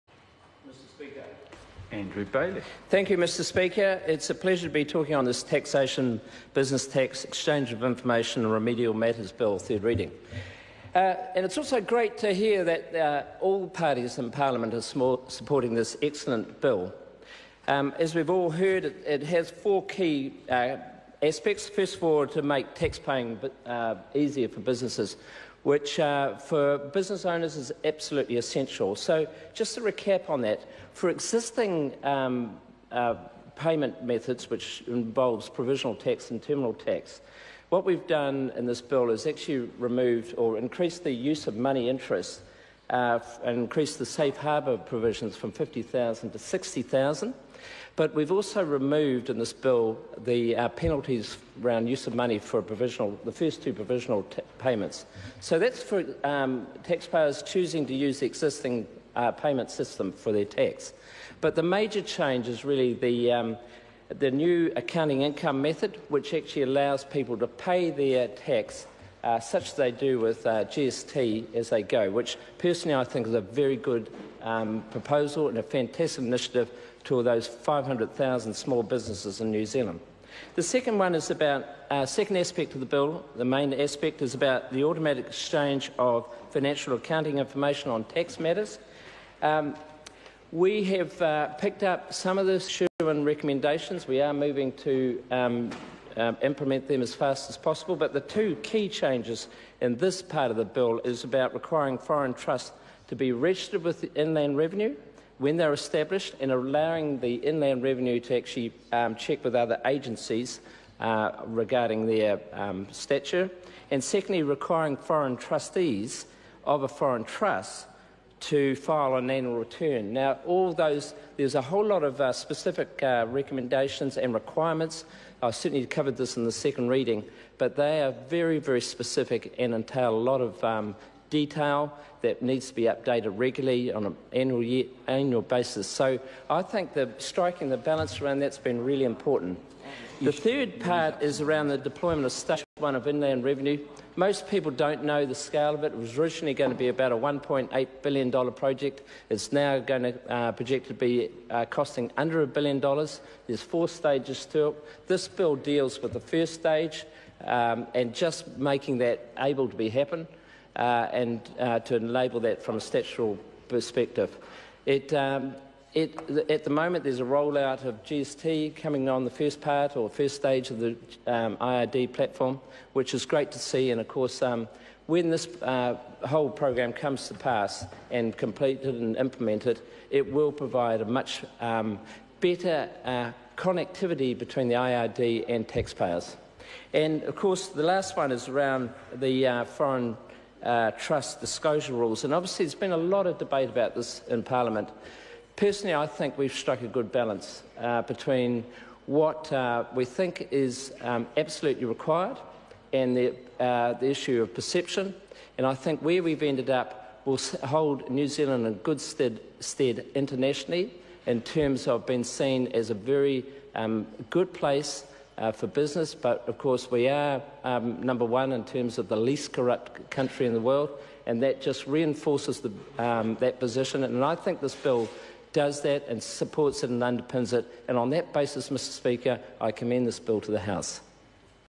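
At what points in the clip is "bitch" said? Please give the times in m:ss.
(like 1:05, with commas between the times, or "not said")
not said.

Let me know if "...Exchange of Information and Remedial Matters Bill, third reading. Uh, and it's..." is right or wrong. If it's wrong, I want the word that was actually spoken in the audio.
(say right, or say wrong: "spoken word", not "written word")
right.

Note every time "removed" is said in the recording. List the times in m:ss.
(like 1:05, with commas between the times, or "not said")
0:39, 0:48.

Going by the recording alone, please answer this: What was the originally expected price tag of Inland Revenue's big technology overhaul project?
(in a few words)
$1.8 billion.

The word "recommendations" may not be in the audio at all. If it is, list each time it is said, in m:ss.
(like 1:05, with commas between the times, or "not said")
1:33, 2:03.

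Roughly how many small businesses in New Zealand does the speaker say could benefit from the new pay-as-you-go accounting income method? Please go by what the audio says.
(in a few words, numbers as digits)
500,000.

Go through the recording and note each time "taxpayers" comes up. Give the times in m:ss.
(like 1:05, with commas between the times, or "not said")
0:56, 3:05.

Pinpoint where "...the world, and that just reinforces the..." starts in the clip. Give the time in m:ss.
3:40.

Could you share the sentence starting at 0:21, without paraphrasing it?
First of all, to make tax paying uh, easier for businesses, which uh, for business owners is absolutely essential.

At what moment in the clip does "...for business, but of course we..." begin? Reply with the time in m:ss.
3:35.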